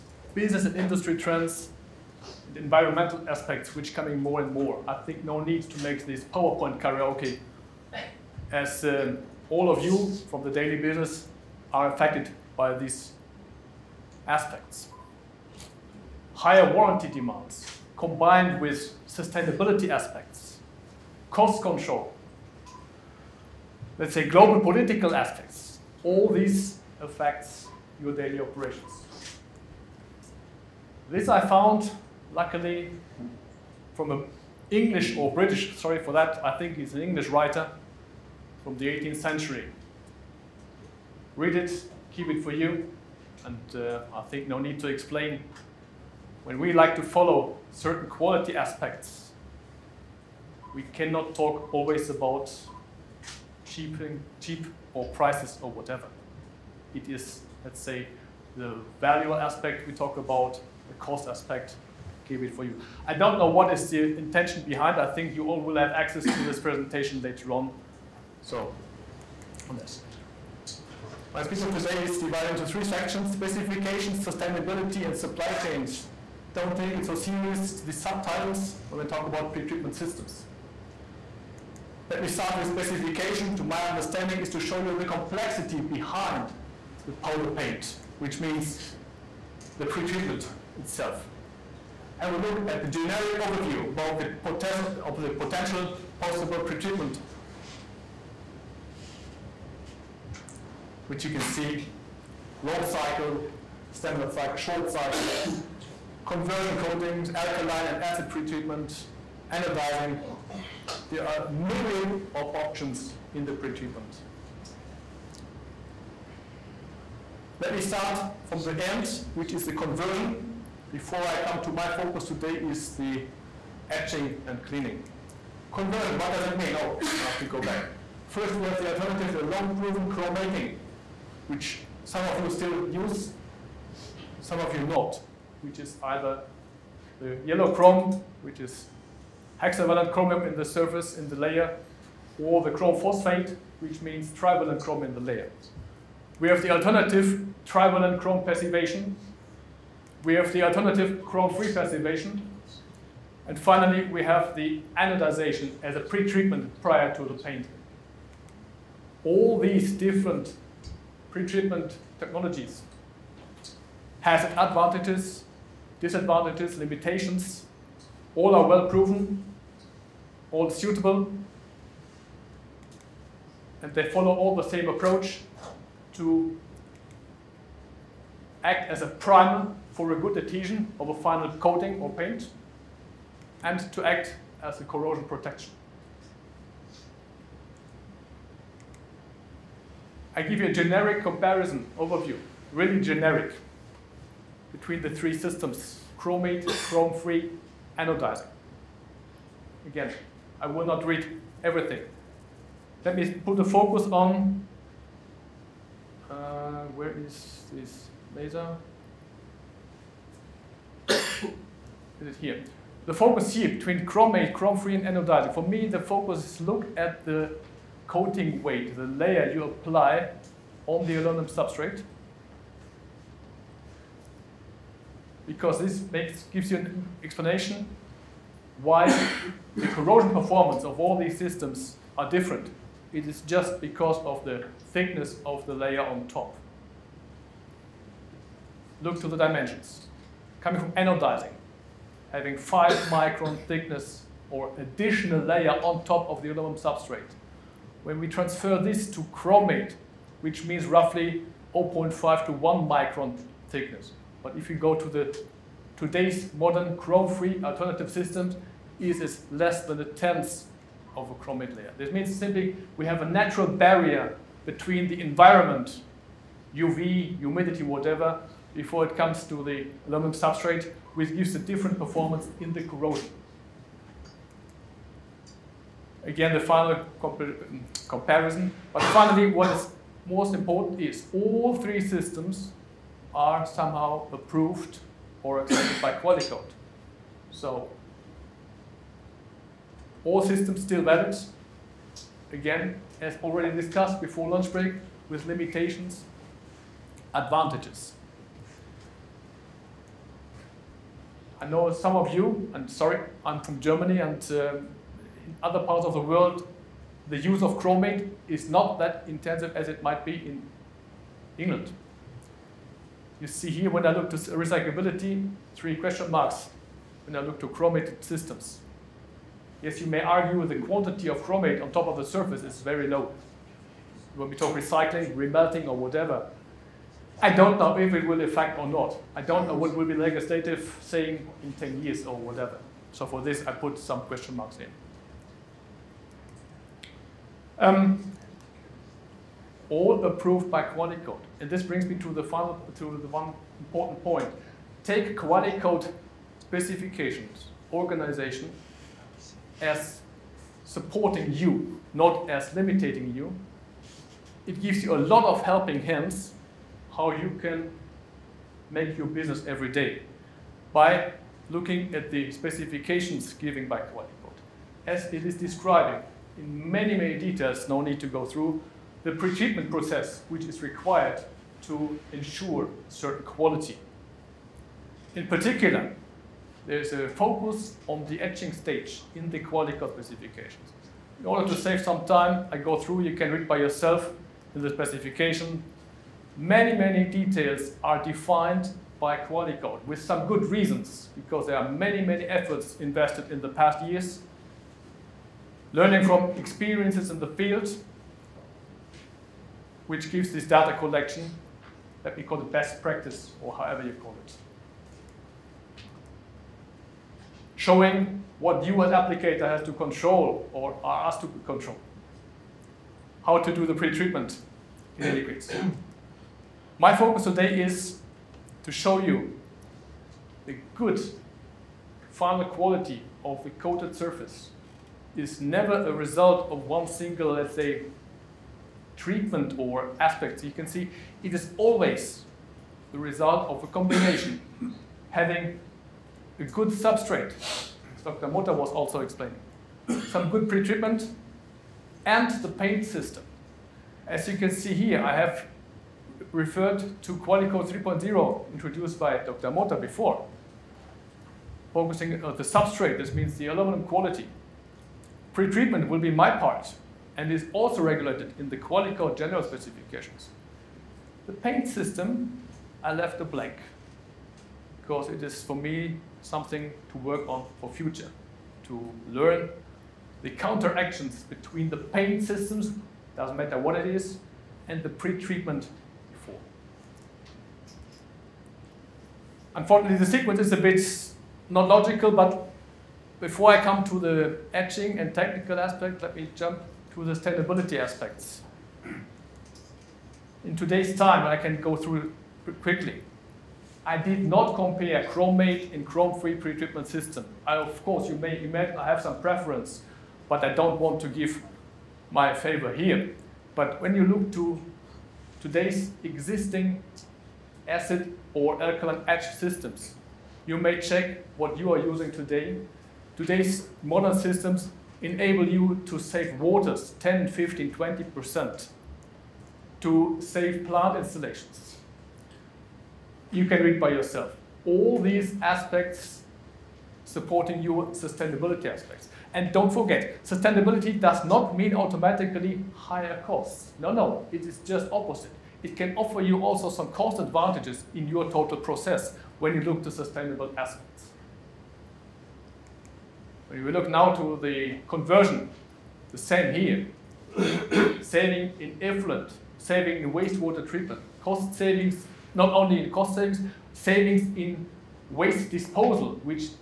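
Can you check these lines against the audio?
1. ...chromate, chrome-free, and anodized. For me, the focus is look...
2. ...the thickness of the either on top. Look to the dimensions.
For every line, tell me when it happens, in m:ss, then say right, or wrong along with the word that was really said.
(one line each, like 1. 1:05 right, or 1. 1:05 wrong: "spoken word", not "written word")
1. 3:34 right
2. 3:54 wrong: "layer", not "either".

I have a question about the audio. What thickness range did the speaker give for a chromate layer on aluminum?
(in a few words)
0.5 to 1 micron.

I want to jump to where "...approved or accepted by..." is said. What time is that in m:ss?
4:44.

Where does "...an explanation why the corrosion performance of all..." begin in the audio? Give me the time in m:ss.
3:46.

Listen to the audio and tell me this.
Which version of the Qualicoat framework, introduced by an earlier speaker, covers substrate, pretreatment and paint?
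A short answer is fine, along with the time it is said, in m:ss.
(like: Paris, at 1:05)
Qualicoat 3.0, at 7:27.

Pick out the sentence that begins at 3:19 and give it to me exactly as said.
Again, I will not read everything.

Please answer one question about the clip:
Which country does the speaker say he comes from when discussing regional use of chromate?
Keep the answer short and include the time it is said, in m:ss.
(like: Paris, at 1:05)
Germany, at 5:03.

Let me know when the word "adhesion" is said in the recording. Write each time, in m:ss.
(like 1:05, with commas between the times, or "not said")
3:00.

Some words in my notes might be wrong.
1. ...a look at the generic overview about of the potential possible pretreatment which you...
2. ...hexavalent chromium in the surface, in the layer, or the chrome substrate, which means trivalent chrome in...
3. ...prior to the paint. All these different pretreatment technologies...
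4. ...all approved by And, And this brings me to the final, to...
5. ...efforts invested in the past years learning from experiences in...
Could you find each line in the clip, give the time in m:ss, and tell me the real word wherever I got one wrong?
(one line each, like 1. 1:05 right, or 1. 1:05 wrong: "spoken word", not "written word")
1. 1:32 right
2. 2:19 wrong: "phosphate", not "substrate"
3. 2:36 right
4. 5:39 wrong: "Qualicoat", not "And"
5. 6:32 right.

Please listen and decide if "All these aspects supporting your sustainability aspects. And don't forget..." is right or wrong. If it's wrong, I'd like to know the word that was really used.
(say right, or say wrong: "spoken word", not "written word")
right.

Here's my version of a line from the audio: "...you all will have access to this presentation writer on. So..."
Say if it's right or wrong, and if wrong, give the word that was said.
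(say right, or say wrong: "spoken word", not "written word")
wrong: "later", not "writer".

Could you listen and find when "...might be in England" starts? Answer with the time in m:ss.
5:10.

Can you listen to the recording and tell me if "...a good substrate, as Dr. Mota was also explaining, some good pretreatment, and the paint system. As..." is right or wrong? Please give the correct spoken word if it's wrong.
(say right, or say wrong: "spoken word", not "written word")
right.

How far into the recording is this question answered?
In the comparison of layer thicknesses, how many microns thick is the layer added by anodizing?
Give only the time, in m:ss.
4:02.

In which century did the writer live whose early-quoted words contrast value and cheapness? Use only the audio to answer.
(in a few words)
18th century.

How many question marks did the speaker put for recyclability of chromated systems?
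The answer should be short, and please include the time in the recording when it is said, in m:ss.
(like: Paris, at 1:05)
3, at 5:15.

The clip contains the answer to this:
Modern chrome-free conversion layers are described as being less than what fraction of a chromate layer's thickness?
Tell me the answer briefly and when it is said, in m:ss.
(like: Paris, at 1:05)
A tenth, at 4:20.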